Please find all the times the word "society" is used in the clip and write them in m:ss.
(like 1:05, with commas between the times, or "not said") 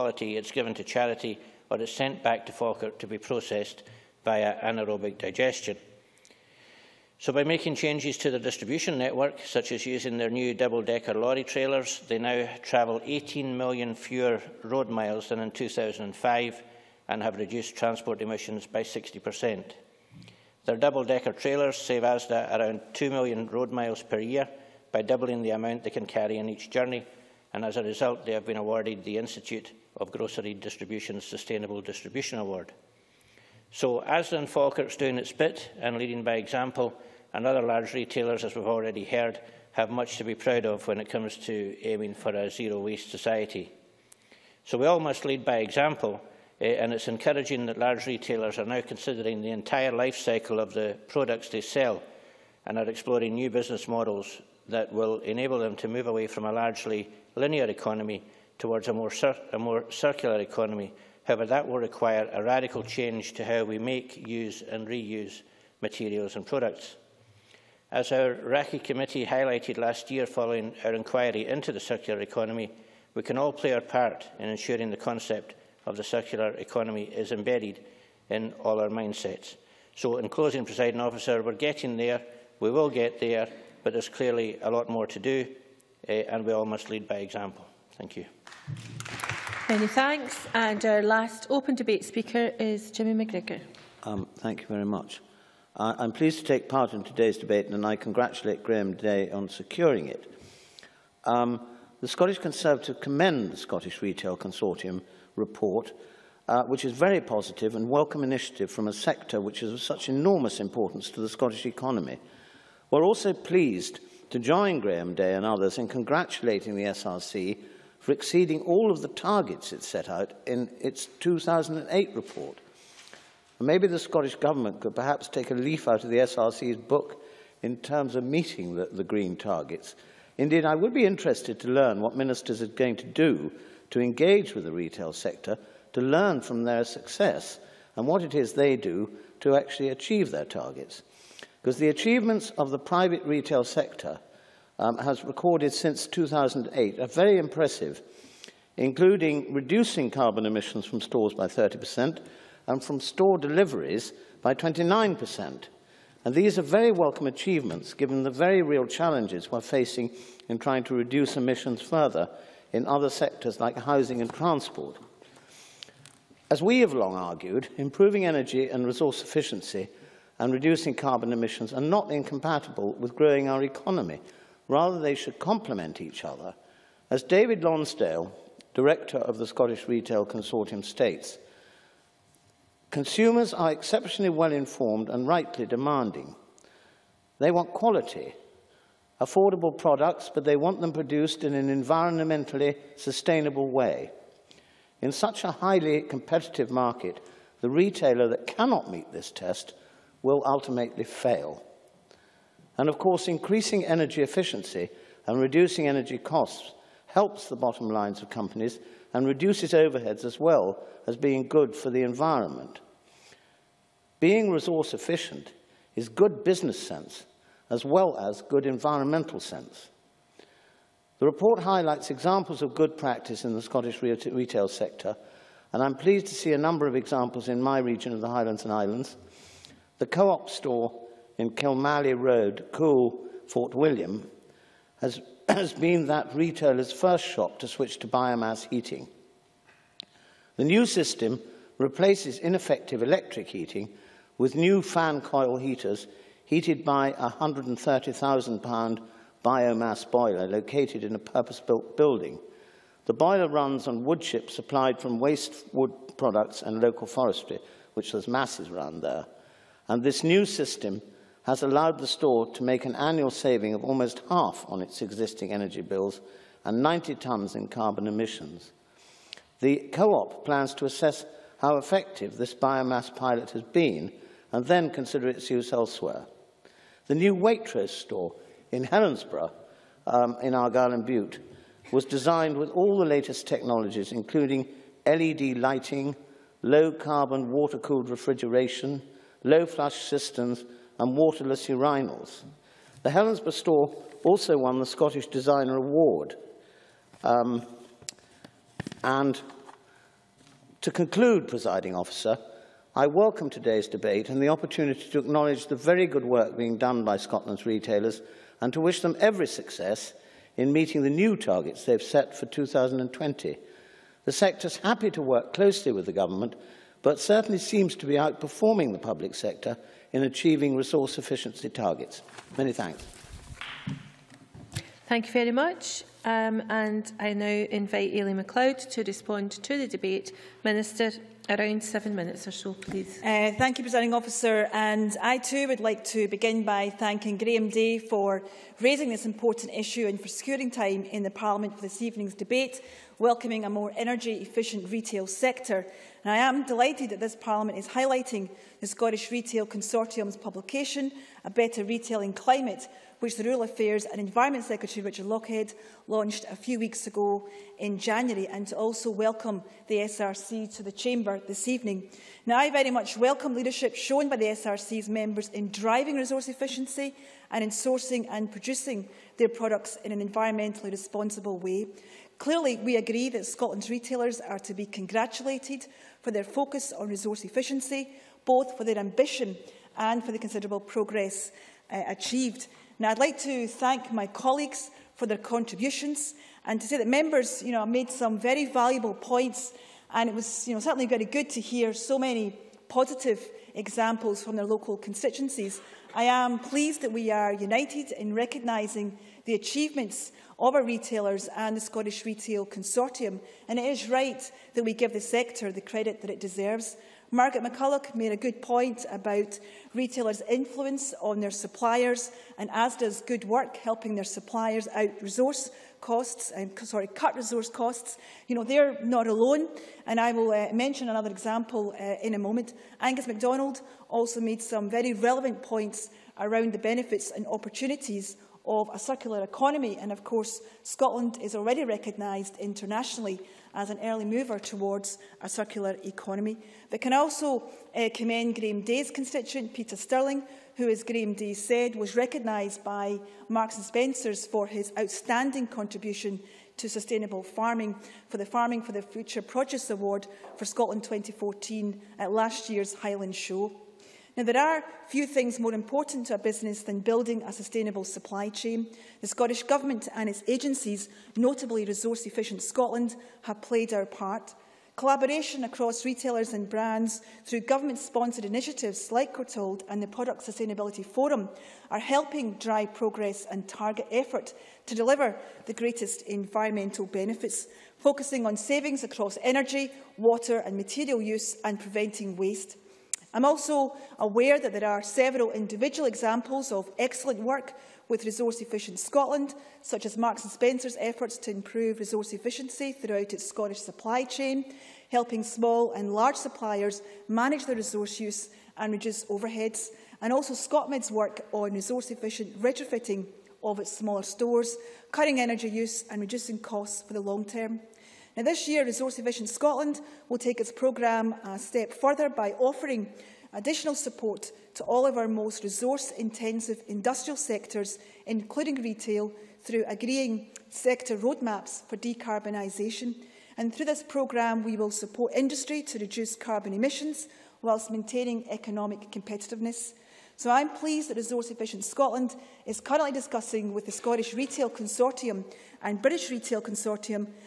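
0:43.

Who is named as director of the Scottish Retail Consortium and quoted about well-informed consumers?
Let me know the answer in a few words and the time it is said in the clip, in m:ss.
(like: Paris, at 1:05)
David Lonsdale, at 2:57.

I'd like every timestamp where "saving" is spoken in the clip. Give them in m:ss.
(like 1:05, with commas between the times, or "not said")
4:23, 7:58.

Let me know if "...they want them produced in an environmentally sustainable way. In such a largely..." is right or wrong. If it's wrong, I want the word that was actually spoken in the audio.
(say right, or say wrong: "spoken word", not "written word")
wrong: "highly", not "largely".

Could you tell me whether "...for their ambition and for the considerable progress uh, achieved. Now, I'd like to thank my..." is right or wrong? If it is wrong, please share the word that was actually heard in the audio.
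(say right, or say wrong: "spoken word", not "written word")
right.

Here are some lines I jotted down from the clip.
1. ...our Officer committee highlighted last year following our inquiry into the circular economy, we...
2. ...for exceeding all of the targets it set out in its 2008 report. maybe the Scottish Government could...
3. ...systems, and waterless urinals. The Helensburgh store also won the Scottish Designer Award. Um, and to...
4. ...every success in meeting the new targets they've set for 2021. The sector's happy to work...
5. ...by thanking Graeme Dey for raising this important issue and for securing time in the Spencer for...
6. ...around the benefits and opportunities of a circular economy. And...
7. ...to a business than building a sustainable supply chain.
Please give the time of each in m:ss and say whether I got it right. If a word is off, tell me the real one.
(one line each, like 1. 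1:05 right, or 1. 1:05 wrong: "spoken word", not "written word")
1. 1:08 wrong: "RACCE", not "Officer"
2. 1:57 right
3. 4:50 right
4. 5:09 wrong: "2020", not "2021"
5. 5:36 wrong: "Parliament", not "Spencer"
6. 7:06 right
7. 7:36 right.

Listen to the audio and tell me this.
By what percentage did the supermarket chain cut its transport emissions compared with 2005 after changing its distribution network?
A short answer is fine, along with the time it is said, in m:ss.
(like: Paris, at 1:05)
60%, at 0:18.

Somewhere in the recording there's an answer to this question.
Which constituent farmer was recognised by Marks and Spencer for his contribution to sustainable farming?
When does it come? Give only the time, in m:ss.
7:19.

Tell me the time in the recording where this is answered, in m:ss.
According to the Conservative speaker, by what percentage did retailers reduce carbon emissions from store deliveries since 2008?
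2:34.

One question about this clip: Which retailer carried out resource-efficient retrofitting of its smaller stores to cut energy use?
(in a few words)
Scotmid.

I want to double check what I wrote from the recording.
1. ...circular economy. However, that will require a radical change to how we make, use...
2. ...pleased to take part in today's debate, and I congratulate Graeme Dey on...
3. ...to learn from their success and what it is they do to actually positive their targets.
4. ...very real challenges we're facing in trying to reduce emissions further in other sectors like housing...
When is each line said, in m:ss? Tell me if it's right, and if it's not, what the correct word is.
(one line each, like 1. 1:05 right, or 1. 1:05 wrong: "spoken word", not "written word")
1. 0:59 right
2. 1:36 right
3. 2:15 wrong: "achieve", not "positive"
4. 2:38 right.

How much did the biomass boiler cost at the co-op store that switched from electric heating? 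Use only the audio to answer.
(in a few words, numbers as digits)
£130,000.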